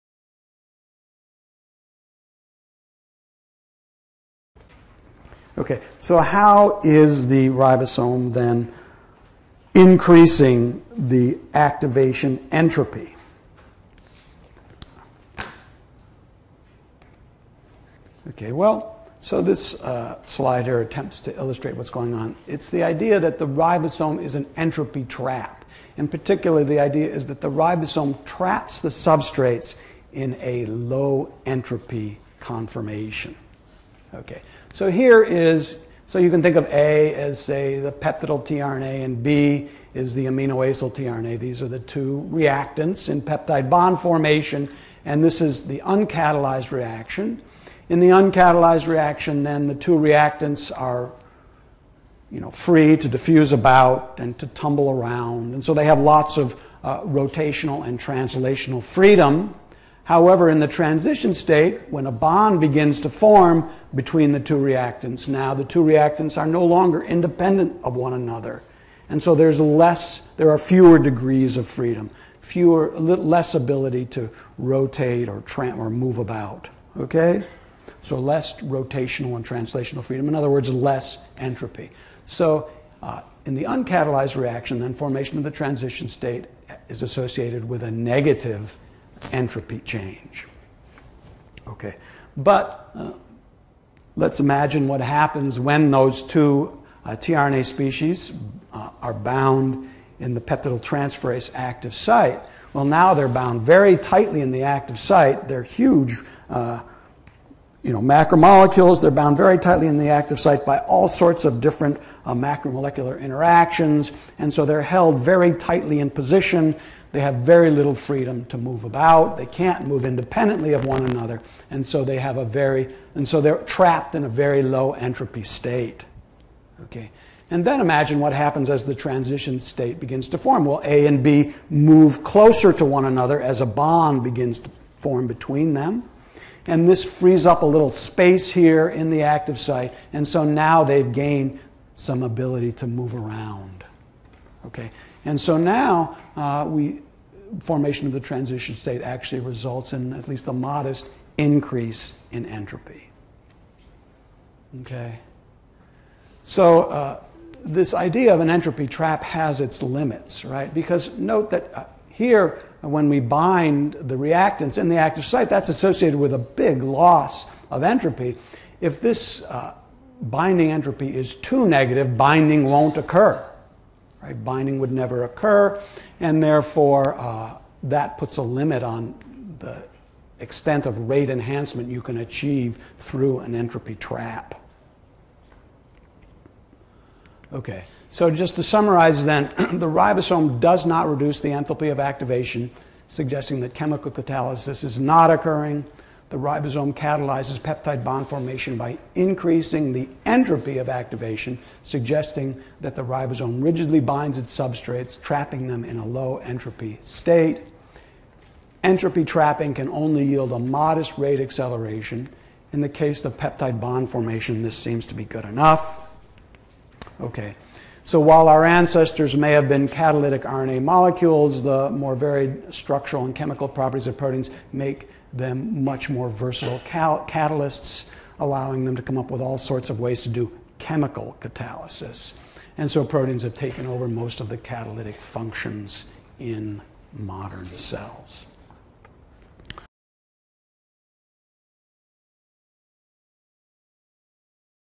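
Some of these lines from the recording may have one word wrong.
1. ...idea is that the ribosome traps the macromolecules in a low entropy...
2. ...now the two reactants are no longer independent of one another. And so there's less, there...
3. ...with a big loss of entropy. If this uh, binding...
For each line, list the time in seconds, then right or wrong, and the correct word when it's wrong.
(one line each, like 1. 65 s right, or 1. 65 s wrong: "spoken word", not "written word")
1. 26 s wrong: "substrates", not "macromolecules"
2. 65 s right
3. 166 s right.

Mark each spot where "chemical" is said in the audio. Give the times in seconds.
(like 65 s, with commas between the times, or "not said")
193 s, 223 s, 230 s.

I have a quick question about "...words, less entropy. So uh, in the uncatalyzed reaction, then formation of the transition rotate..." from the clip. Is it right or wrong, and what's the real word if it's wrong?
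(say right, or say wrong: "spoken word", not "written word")
wrong: "state", not "rotate".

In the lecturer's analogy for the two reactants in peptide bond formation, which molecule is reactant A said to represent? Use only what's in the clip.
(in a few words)
peptidyl tRNA.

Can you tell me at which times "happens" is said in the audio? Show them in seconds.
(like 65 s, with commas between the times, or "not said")
95 s, 128 s.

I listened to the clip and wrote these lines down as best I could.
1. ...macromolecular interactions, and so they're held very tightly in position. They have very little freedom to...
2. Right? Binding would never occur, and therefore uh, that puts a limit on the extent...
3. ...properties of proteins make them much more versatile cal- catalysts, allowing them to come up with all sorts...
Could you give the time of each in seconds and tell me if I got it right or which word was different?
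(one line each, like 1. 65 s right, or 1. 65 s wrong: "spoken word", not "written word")
1. 112 s right
2. 174 s right
3. 223 s right.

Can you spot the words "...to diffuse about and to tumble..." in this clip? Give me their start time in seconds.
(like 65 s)
52 s.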